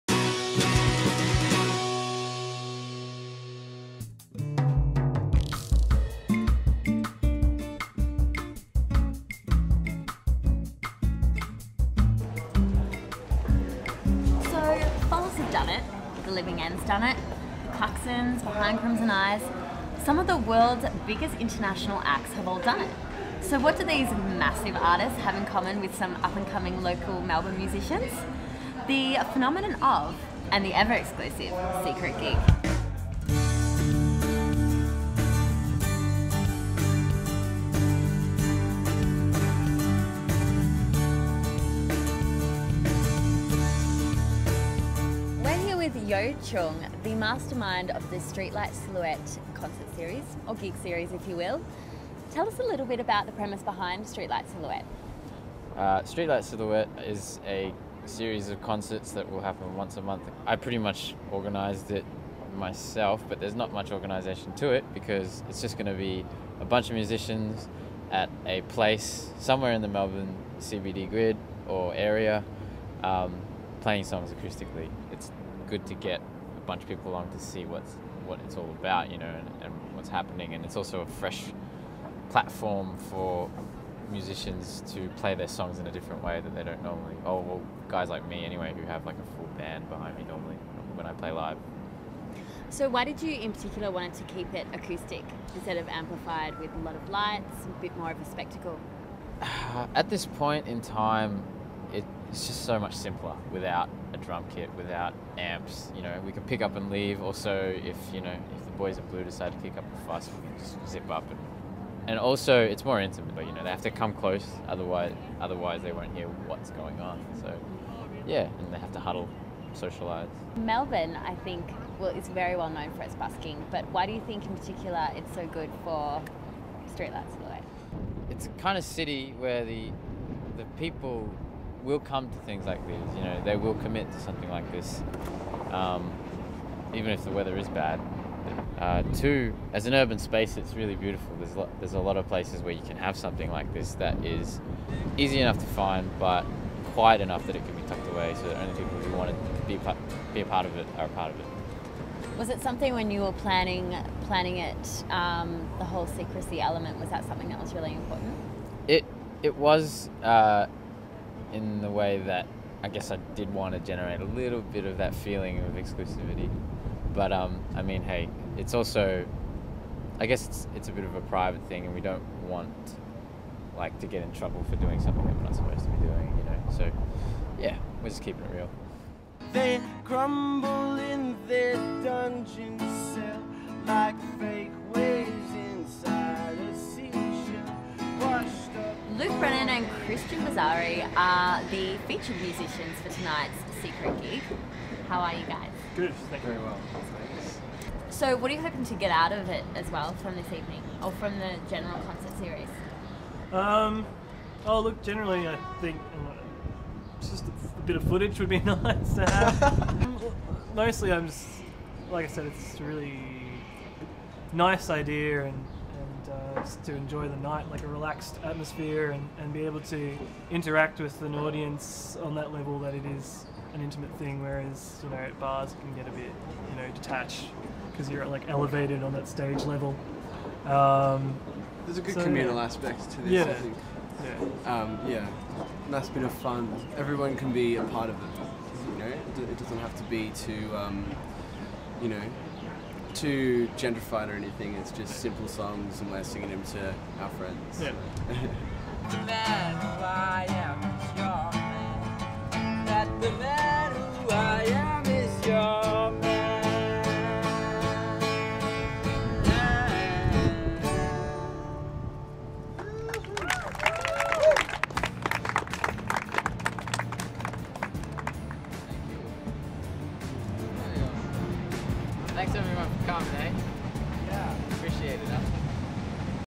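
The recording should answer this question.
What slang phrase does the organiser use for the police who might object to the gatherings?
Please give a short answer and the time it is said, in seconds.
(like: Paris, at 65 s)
The boys in blue, at 108 s.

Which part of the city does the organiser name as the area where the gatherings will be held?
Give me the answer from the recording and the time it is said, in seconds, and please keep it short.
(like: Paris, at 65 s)
Melbourne CBD, at 69 s.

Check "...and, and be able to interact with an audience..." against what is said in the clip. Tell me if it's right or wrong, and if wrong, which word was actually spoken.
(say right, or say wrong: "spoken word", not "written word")
right.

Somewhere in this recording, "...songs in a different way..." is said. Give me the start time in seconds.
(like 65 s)
85 s.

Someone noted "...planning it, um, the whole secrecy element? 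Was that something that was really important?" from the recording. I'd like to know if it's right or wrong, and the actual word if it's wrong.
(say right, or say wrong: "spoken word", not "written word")
right.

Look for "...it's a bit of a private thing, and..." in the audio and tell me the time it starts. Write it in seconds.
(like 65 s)
170 s.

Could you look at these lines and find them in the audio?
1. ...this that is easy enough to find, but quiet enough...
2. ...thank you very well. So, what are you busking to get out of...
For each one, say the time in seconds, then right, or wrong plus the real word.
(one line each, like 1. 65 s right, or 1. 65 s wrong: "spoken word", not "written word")
1. 143 s right
2. 196 s wrong: "hoping", not "busking".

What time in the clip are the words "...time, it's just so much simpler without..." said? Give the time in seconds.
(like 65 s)
100 s.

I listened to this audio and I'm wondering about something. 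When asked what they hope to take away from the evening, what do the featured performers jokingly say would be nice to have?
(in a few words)
Footage.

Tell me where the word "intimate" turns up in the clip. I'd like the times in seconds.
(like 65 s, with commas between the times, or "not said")
112 s, 223 s.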